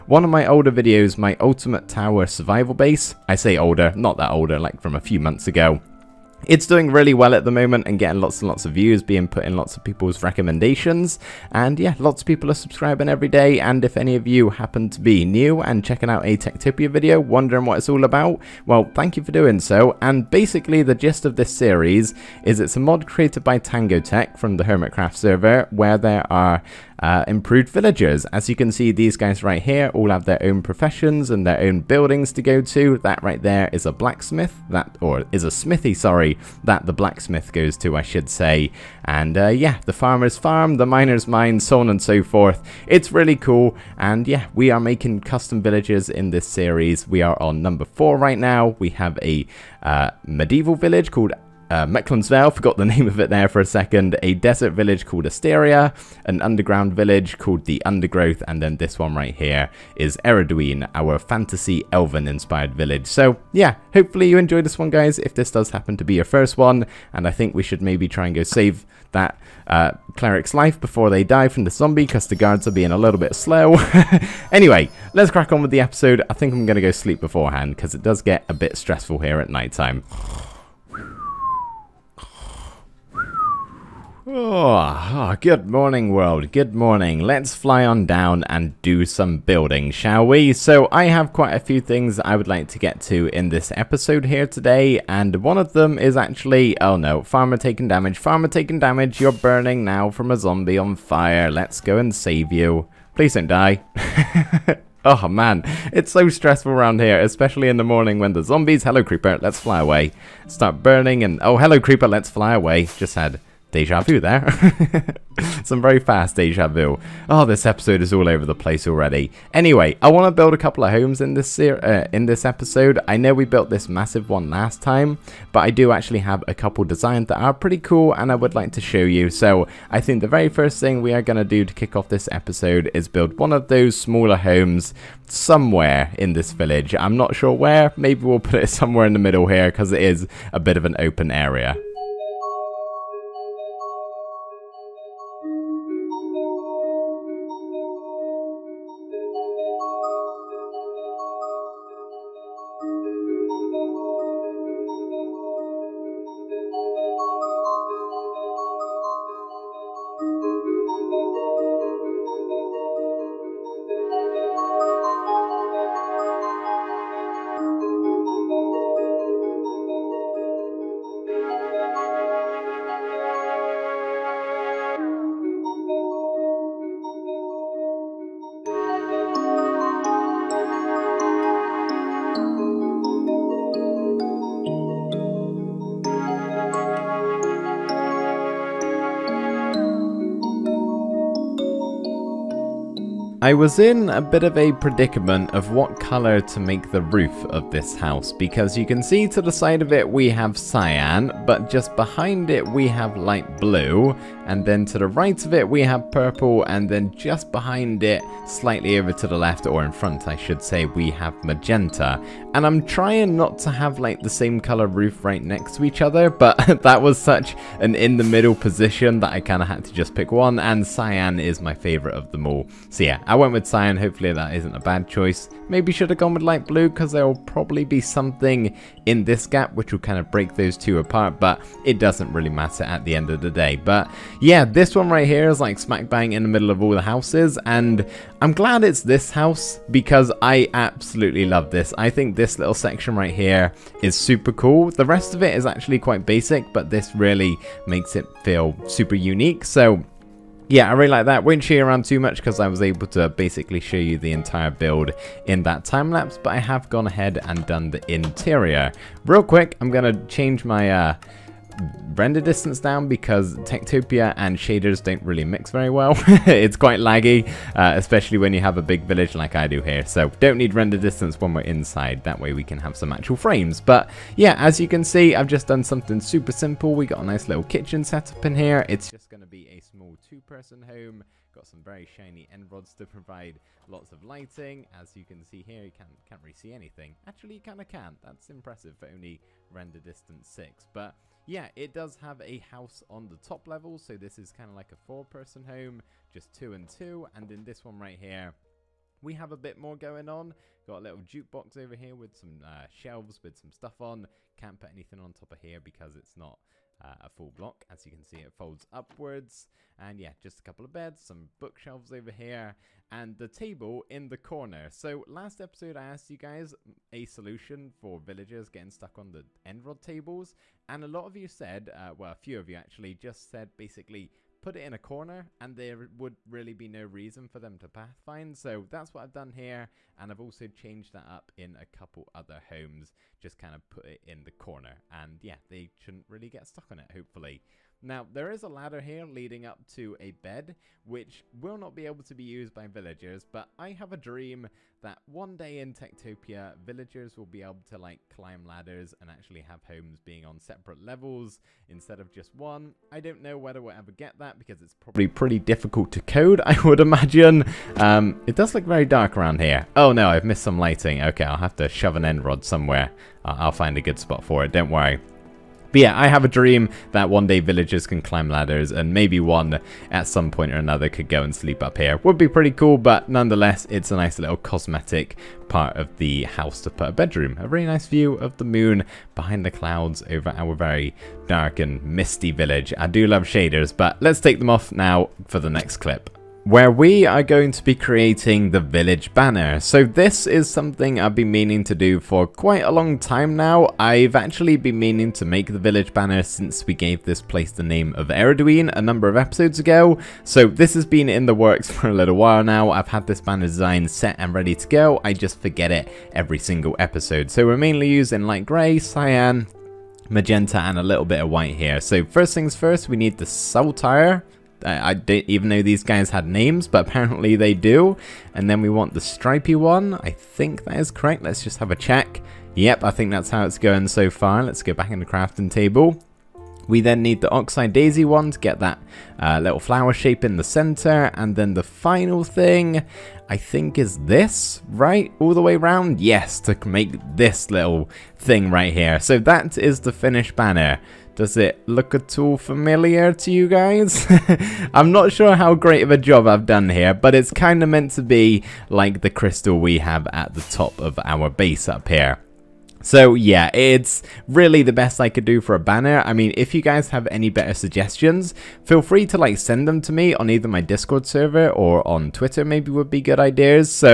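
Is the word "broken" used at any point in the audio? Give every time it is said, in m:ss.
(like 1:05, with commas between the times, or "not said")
not said.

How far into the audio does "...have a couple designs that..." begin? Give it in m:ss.
2:06.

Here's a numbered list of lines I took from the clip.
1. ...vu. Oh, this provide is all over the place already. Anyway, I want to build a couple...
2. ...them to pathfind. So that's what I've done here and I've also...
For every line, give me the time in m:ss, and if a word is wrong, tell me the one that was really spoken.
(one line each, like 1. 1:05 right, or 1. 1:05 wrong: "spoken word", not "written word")
1. 1:56 wrong: "episode", not "provide"
2. 5:27 right.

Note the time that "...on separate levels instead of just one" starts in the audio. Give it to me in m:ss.
5:50.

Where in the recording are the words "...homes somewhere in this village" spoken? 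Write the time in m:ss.
2:14.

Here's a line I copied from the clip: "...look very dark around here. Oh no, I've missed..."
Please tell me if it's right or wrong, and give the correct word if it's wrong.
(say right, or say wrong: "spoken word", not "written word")
right.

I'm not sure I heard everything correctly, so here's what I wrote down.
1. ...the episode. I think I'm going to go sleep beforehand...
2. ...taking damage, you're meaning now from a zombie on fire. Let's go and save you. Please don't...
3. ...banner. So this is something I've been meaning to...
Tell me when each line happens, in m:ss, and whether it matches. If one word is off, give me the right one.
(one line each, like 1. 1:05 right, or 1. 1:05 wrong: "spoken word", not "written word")
1. 1:15 right
2. 1:38 wrong: "burning", not "meaning"
3. 6:29 right.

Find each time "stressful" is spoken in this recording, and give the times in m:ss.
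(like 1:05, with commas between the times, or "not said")
1:18, 1:46.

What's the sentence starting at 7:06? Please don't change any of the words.
We then need the Oxeye Daisy one to get that uh, little flower shape in the center.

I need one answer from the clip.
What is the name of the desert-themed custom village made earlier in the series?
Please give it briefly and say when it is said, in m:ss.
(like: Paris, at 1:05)
Asteria, at 0:55.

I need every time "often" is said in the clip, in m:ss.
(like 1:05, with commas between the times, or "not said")
not said.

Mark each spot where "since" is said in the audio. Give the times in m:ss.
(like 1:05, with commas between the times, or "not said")
6:36.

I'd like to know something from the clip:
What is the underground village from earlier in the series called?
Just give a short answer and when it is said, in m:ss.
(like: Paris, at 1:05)
The Undergrowth, at 0:57.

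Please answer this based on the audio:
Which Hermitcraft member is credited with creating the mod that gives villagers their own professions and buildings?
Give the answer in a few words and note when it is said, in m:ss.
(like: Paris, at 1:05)
TangoTek, at 0:23.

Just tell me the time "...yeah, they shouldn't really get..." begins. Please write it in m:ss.
5:35.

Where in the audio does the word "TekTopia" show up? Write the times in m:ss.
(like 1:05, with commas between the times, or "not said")
0:16, 4:23, 5:45.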